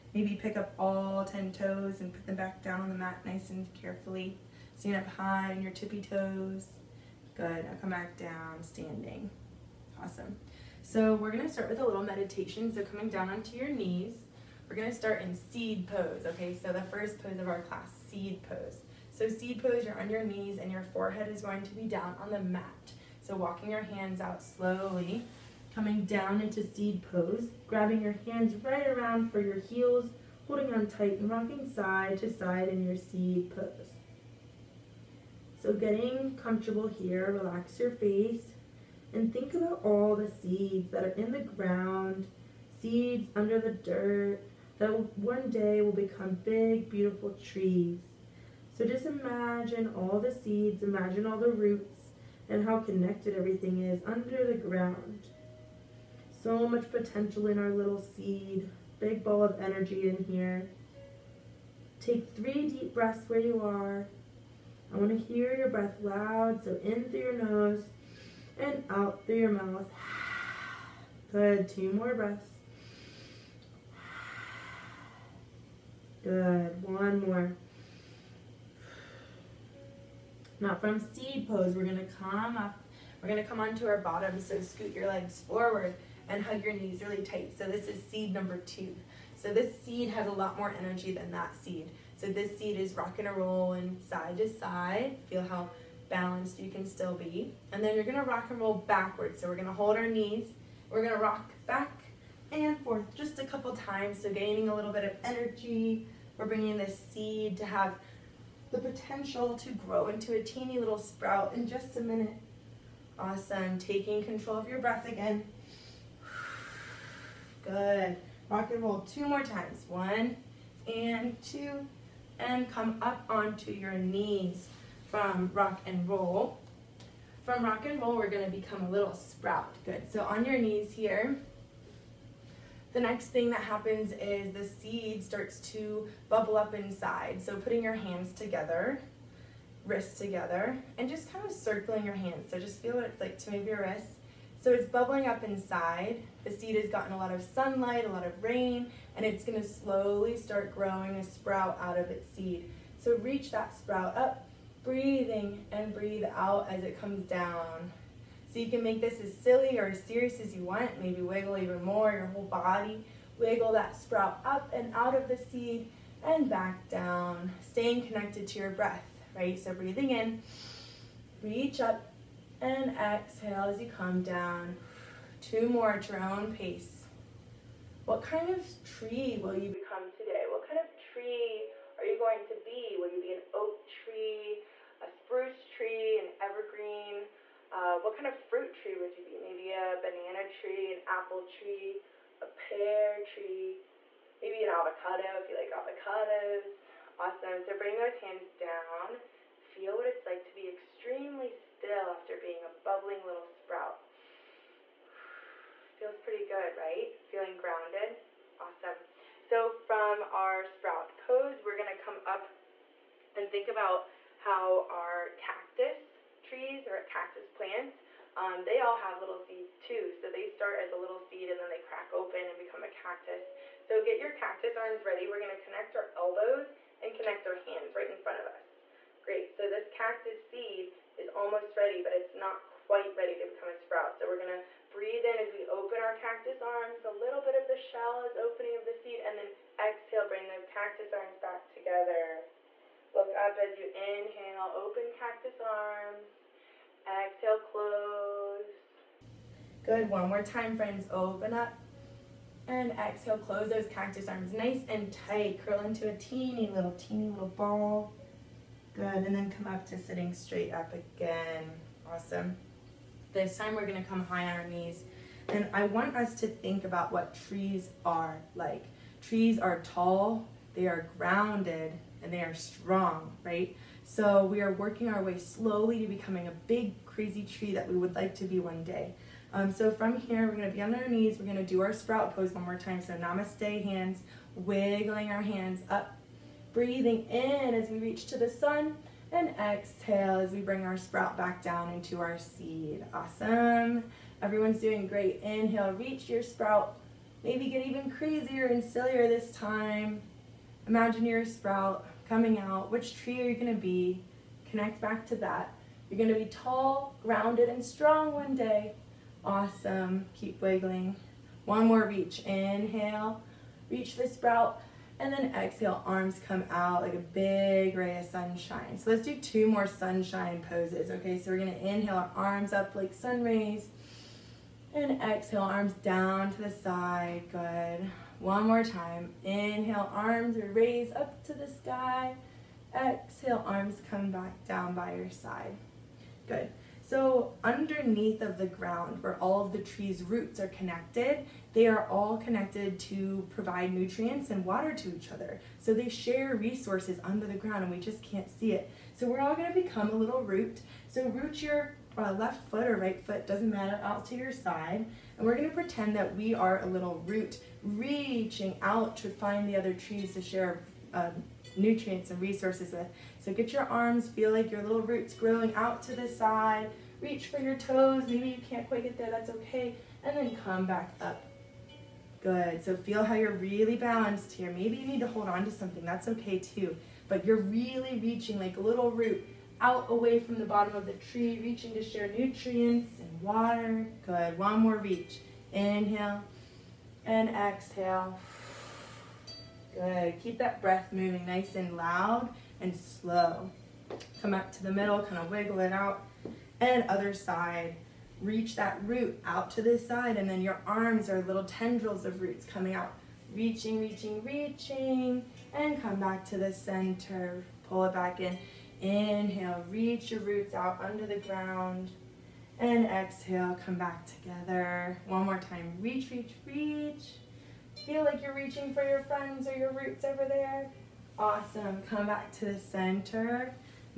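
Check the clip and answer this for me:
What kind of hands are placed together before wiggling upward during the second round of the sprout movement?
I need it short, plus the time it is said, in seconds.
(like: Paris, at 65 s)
namaste hands, at 283 s.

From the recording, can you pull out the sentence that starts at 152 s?
So reach that sprout up, breathing and breathe out as it comes down.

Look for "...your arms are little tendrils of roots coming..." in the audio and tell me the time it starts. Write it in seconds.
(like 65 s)
400 s.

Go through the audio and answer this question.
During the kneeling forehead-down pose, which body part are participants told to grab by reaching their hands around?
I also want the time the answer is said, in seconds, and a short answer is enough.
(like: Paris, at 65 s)
heels, at 29 s.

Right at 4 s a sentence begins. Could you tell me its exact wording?
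Stand up high on your tippy toes.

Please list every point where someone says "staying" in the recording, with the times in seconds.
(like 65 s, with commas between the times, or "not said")
167 s.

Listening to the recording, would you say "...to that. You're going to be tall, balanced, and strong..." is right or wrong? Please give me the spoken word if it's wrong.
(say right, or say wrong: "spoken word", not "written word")
wrong: "grounded", not "balanced".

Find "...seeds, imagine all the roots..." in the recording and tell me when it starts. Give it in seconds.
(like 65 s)
50 s.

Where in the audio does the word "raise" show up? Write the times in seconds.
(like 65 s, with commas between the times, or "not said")
330 s.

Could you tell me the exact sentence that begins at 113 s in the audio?
Awesome, taking control of your breath again.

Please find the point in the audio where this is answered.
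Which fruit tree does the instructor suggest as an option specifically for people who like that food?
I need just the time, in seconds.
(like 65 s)
194 s.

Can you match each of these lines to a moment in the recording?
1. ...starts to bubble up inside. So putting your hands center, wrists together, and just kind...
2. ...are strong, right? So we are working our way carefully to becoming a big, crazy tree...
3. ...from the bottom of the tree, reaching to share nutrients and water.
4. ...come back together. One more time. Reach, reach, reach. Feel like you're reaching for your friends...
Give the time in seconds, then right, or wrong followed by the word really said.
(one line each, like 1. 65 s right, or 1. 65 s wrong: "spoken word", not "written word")
1. 135 s wrong: "together", not "center"
2. 272 s wrong: "slowly", not "carefully"
3. 380 s right
4. 413 s right.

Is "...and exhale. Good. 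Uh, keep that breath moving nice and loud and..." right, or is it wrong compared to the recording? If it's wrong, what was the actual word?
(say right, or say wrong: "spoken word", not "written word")
right.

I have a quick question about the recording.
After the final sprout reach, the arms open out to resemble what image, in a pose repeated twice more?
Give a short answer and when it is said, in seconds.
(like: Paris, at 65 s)
ray of sunshine, at 317 s.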